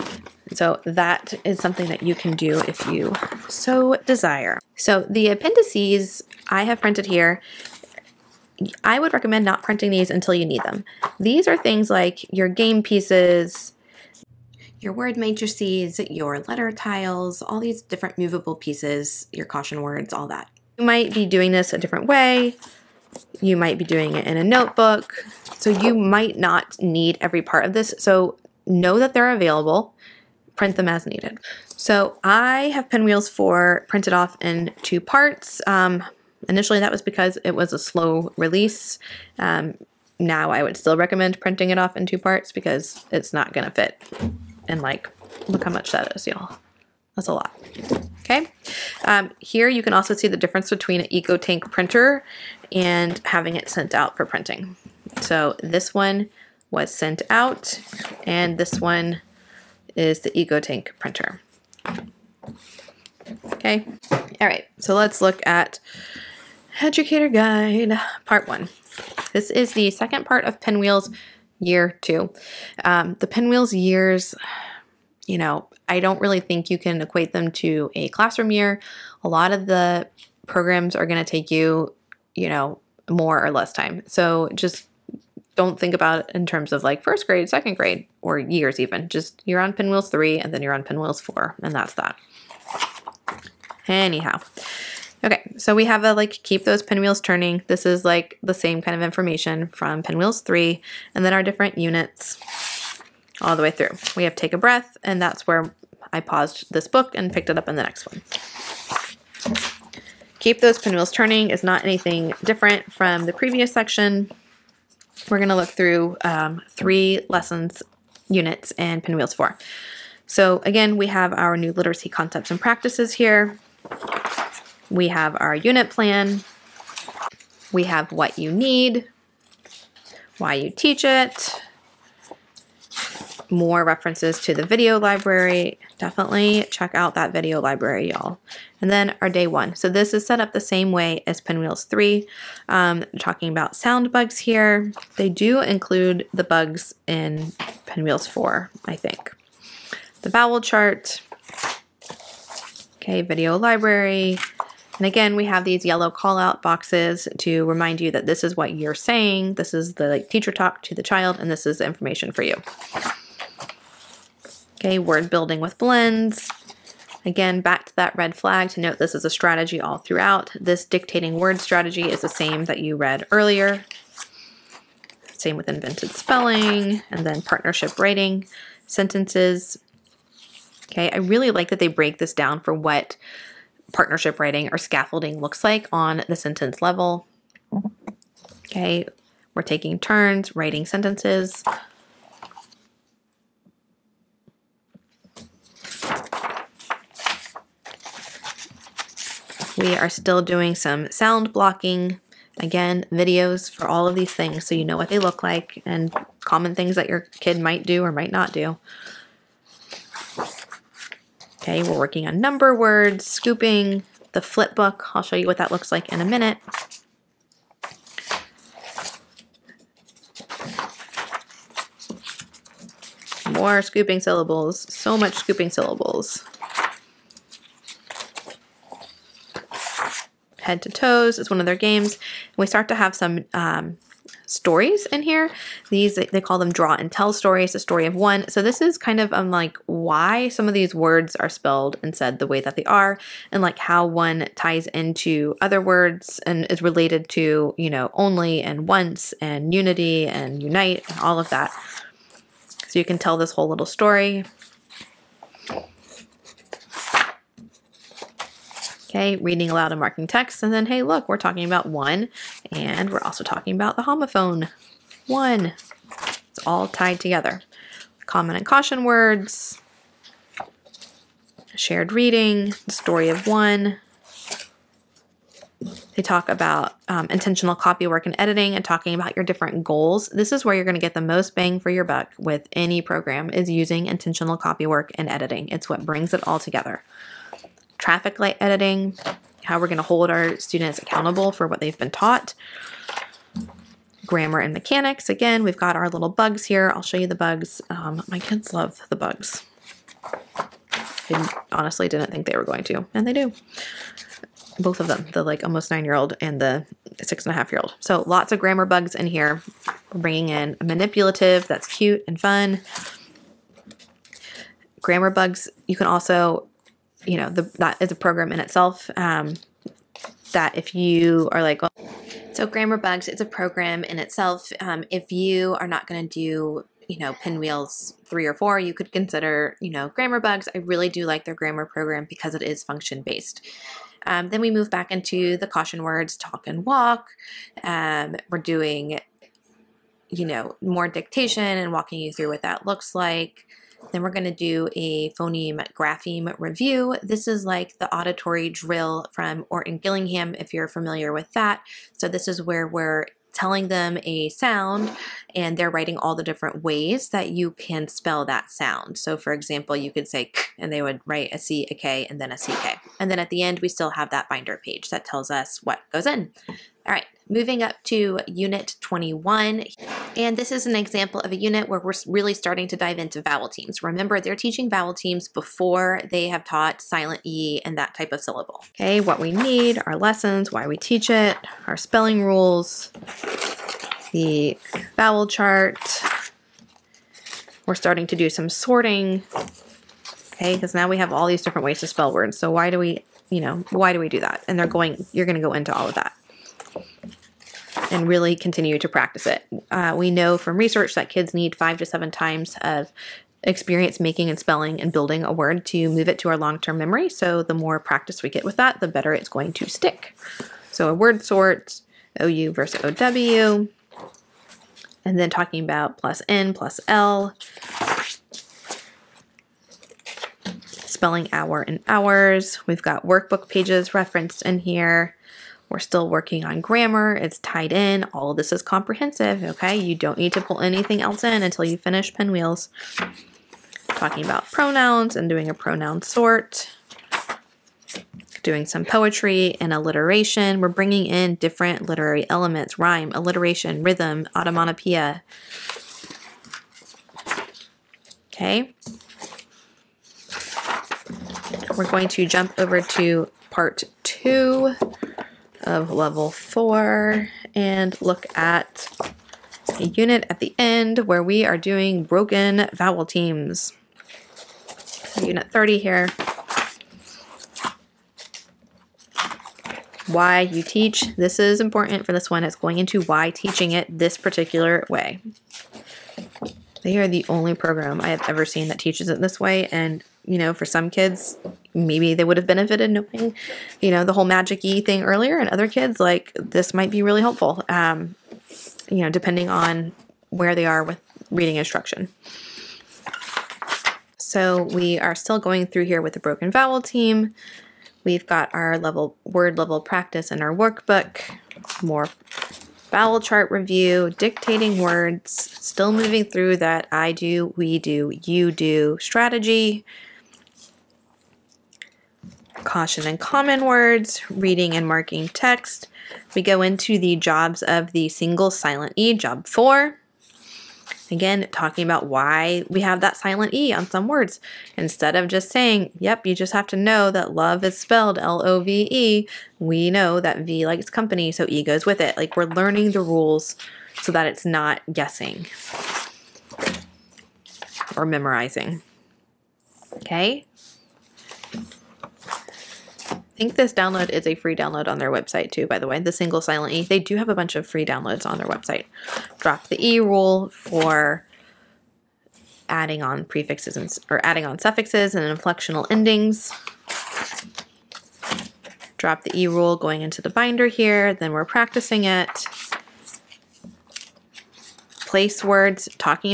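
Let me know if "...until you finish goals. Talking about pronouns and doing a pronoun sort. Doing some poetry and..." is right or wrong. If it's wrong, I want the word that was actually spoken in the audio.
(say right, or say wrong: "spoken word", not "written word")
wrong: "pinwheels", not "goals".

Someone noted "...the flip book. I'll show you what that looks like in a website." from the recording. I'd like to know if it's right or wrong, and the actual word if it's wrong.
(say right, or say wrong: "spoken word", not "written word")
wrong: "minute", not "website".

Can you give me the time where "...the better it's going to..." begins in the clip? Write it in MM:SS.
06:49.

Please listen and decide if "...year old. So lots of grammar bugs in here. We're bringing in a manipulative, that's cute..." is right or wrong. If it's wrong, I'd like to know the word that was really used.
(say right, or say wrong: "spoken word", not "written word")
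right.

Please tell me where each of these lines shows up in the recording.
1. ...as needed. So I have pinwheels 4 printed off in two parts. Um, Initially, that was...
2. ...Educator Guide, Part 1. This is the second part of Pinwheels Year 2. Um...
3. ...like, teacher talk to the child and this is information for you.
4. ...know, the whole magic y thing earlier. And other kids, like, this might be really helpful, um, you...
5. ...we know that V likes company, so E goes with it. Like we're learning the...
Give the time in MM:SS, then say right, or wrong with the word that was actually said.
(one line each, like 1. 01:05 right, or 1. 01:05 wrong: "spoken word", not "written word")
1. 00:30 right
2. 01:06 right
3. 02:40 right
4. 08:04 right
5. 08:49 right.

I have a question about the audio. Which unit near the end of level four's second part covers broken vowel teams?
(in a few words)
30.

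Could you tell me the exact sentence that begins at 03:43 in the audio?
More scooping syllables, so much scooping syllables.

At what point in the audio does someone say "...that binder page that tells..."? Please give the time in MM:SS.
06:04.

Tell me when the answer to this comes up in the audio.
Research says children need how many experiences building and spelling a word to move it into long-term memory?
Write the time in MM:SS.
06:41.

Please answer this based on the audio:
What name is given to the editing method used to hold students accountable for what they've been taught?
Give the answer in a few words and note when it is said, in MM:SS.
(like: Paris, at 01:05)
Traffic light editing, at 04:47.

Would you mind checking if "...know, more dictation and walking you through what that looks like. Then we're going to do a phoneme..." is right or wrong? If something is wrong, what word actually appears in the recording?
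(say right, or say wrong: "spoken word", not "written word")
right.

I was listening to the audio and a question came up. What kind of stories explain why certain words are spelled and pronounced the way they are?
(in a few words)
Draw and tell stories.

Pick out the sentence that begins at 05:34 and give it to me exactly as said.
Um, then we move back into the caution words, talk and walk.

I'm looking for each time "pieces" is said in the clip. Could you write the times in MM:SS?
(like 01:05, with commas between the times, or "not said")
00:12, 00:18.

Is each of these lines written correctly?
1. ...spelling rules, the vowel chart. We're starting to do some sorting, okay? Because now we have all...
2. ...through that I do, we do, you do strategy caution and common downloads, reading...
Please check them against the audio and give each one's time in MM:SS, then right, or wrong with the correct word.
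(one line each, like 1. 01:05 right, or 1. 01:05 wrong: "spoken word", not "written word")
1. 06:21 right
2. 08:26 wrong: "words", not "downloads".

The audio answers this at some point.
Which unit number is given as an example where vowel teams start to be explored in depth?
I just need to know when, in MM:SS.
06:09.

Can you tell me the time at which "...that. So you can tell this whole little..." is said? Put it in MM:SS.
04:11.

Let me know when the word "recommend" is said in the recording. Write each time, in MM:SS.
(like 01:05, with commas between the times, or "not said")
00:09, 00:40.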